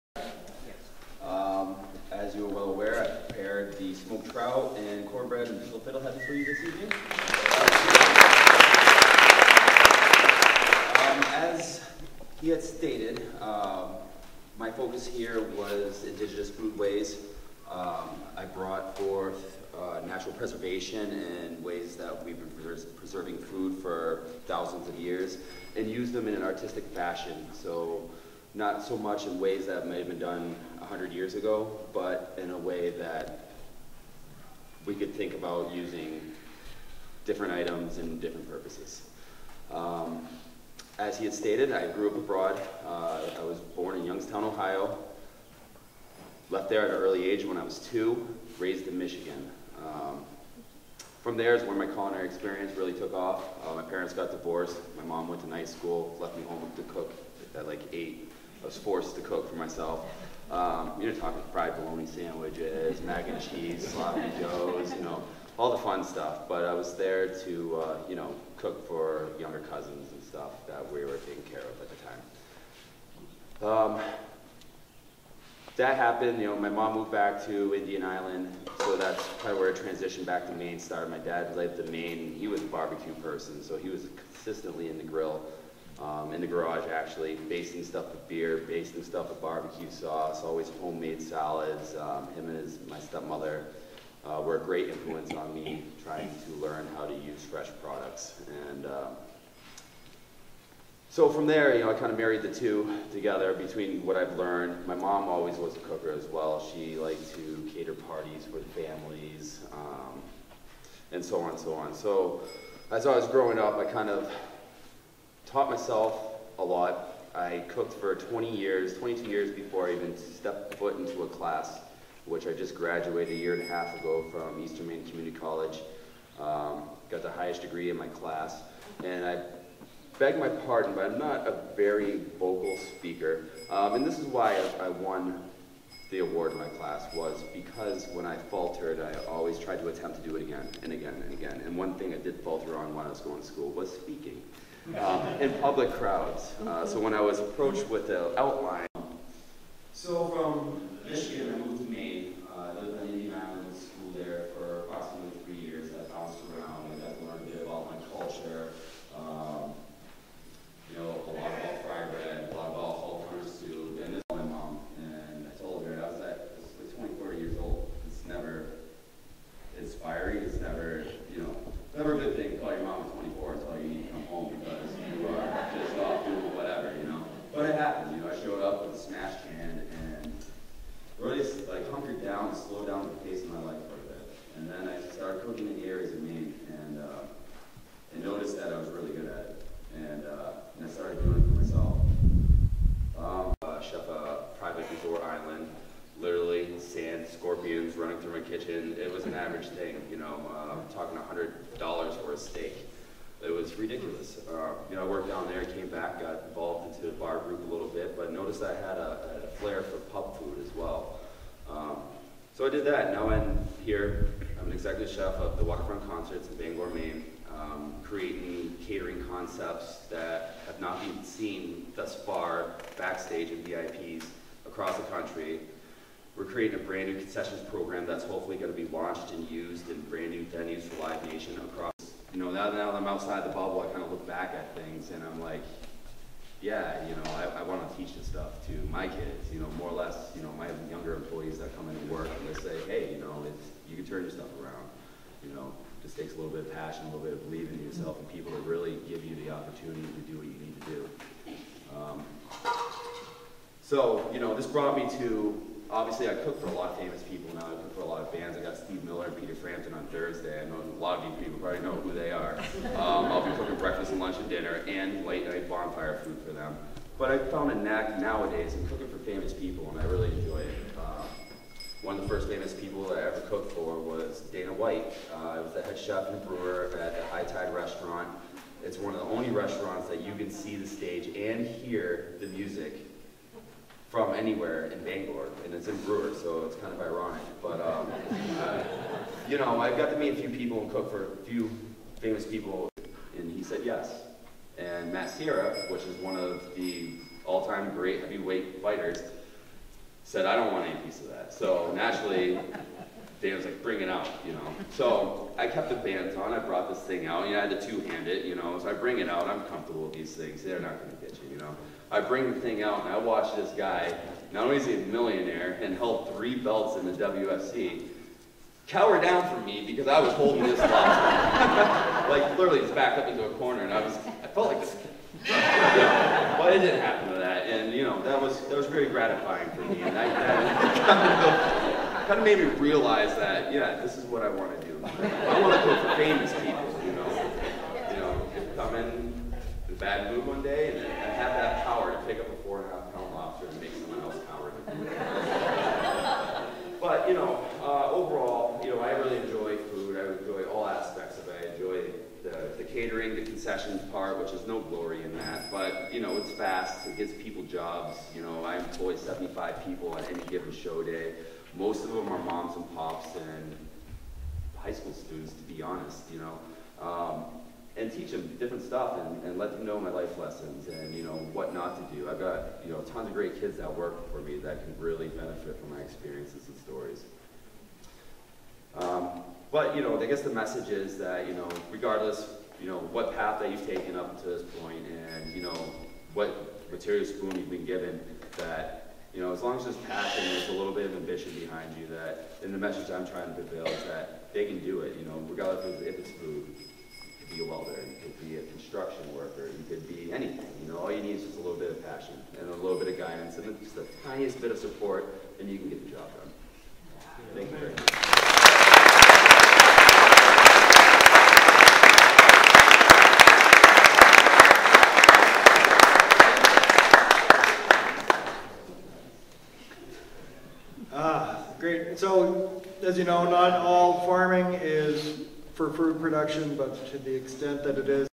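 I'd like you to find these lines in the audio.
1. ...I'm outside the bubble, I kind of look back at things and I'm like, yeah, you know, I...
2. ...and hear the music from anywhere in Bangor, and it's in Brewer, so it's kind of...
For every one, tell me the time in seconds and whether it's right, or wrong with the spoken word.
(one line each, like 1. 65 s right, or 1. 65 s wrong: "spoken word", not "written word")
1. 232 s right
2. 281 s right.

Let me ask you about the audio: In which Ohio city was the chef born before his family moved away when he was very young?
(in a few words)
Youngstown.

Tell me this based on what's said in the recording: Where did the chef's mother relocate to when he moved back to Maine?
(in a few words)
Indian Island.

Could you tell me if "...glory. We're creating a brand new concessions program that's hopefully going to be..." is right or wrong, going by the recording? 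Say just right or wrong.
wrong.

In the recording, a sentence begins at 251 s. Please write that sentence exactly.
Um, so, you know, this brought me to obviously I cook for a lot of famous people now.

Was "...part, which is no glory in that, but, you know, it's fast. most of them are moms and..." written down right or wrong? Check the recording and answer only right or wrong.
right.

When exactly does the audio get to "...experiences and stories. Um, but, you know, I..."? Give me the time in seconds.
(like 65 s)
375 s.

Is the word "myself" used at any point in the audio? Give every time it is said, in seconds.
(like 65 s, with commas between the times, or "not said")
59 s, 115 s.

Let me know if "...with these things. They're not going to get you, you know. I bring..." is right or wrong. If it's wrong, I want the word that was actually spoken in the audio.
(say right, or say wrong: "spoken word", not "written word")
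right.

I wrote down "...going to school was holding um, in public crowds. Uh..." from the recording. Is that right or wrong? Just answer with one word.
wrong.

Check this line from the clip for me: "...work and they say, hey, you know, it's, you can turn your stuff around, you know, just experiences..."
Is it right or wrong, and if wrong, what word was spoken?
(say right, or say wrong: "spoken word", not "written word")
wrong: "takes", not "experiences".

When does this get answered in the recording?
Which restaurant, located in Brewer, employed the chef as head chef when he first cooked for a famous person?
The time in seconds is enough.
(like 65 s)
277 s.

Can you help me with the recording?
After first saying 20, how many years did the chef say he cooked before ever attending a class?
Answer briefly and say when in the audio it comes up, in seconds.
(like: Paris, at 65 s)
22, at 118 s.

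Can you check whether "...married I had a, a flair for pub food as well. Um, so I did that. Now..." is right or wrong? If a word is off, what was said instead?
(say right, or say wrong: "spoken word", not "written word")
wrong: "noticed", not "married".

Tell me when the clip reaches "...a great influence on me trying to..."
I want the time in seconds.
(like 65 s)
94 s.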